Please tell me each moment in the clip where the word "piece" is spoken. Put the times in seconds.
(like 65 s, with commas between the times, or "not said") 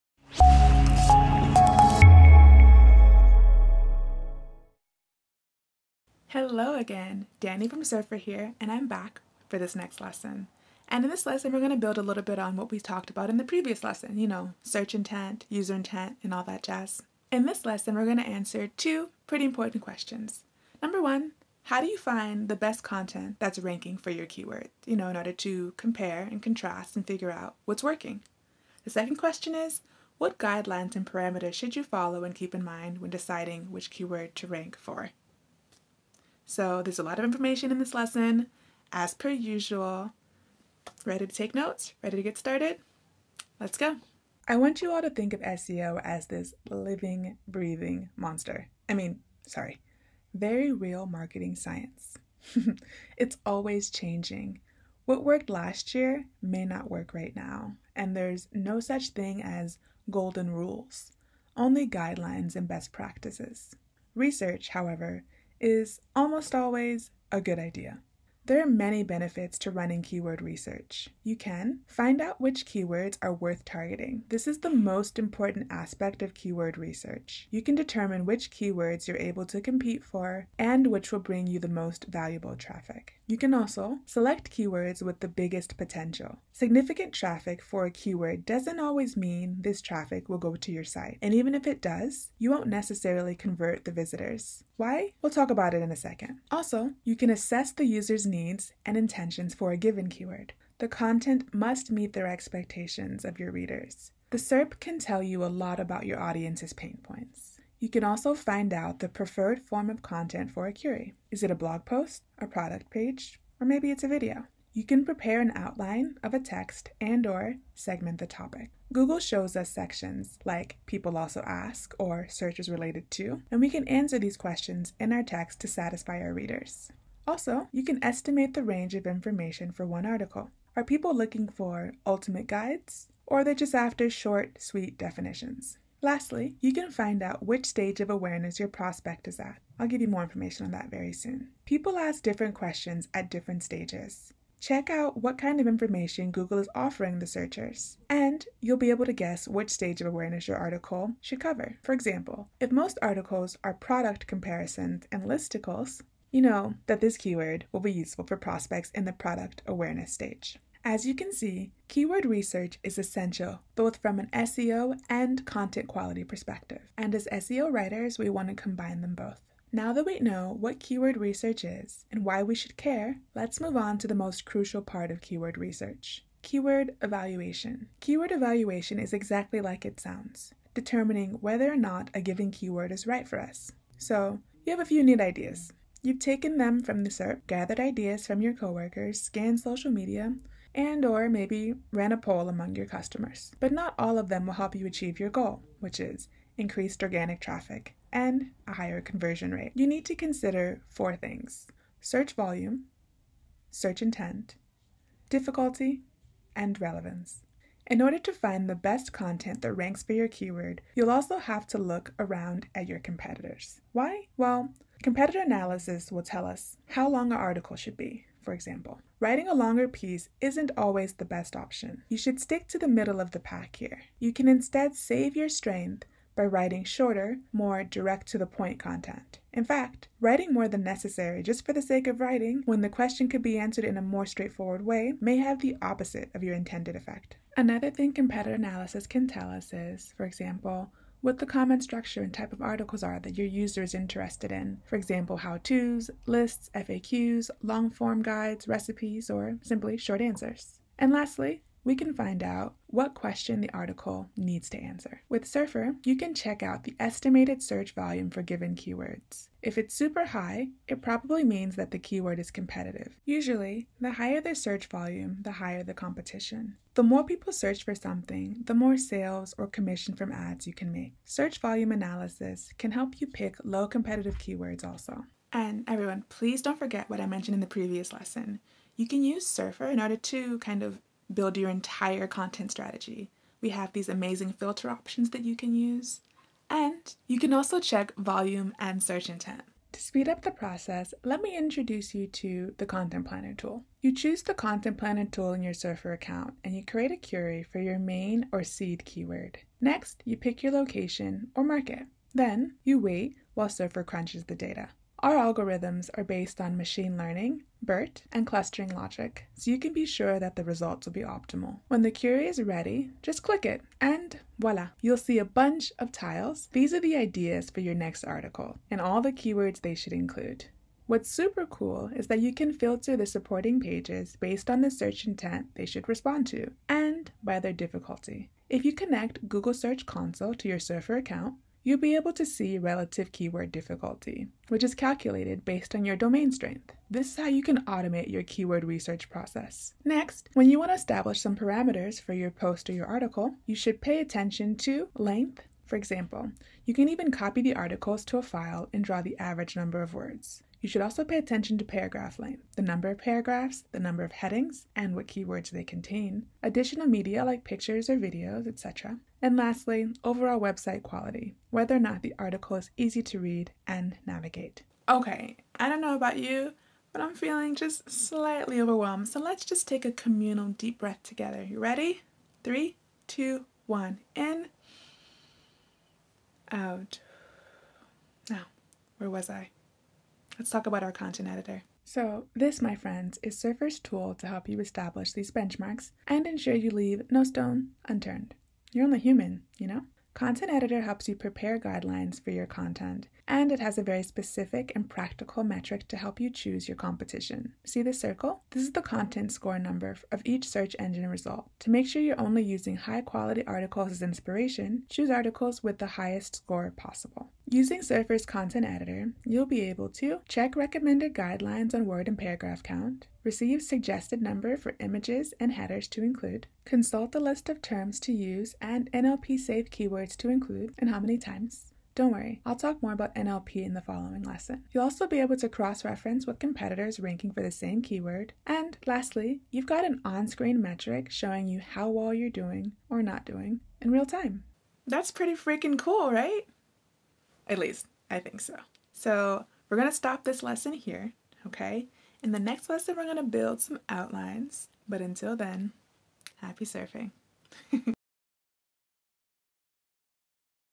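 219 s.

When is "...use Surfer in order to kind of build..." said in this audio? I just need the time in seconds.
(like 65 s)
279 s.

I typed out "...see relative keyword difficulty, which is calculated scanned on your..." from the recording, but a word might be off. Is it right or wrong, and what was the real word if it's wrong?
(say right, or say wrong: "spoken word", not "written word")
wrong: "based", not "scanned".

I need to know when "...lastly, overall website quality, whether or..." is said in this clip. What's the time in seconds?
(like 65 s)
359 s.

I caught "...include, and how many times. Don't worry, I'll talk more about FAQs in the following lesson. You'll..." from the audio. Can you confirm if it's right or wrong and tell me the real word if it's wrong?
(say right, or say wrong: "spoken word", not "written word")
wrong: "NLP", not "FAQs".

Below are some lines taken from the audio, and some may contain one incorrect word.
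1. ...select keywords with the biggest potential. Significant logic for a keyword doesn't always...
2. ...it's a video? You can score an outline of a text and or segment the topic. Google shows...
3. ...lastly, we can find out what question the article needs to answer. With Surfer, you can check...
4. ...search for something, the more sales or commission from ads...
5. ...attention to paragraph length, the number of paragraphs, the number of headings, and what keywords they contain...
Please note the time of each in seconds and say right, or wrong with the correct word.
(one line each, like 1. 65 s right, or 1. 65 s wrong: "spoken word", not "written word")
1. 84 s wrong: "traffic", not "logic"
2. 113 s wrong: "prepare", not "score"
3. 251 s right
4. 267 s right
5. 351 s right.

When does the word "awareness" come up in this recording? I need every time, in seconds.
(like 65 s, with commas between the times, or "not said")
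138 s, 150 s, 159 s.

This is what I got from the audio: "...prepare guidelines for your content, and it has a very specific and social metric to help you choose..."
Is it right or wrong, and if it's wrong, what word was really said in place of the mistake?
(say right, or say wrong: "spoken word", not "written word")
wrong: "practical", not "social".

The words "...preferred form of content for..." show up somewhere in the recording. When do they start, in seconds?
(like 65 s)
109 s.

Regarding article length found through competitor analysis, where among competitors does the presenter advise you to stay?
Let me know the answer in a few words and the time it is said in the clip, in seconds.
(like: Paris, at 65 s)
middle of the pack, at 222 s.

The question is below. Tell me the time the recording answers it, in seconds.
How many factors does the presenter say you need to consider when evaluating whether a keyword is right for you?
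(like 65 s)
200 s.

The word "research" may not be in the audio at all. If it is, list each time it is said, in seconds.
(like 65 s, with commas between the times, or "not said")
64 s, 70 s, 76 s, 162 s, 171 s, 175 s, 338 s.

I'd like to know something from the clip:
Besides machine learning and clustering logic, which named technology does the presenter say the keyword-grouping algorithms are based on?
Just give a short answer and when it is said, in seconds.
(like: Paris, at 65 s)
BERT, at 307 s.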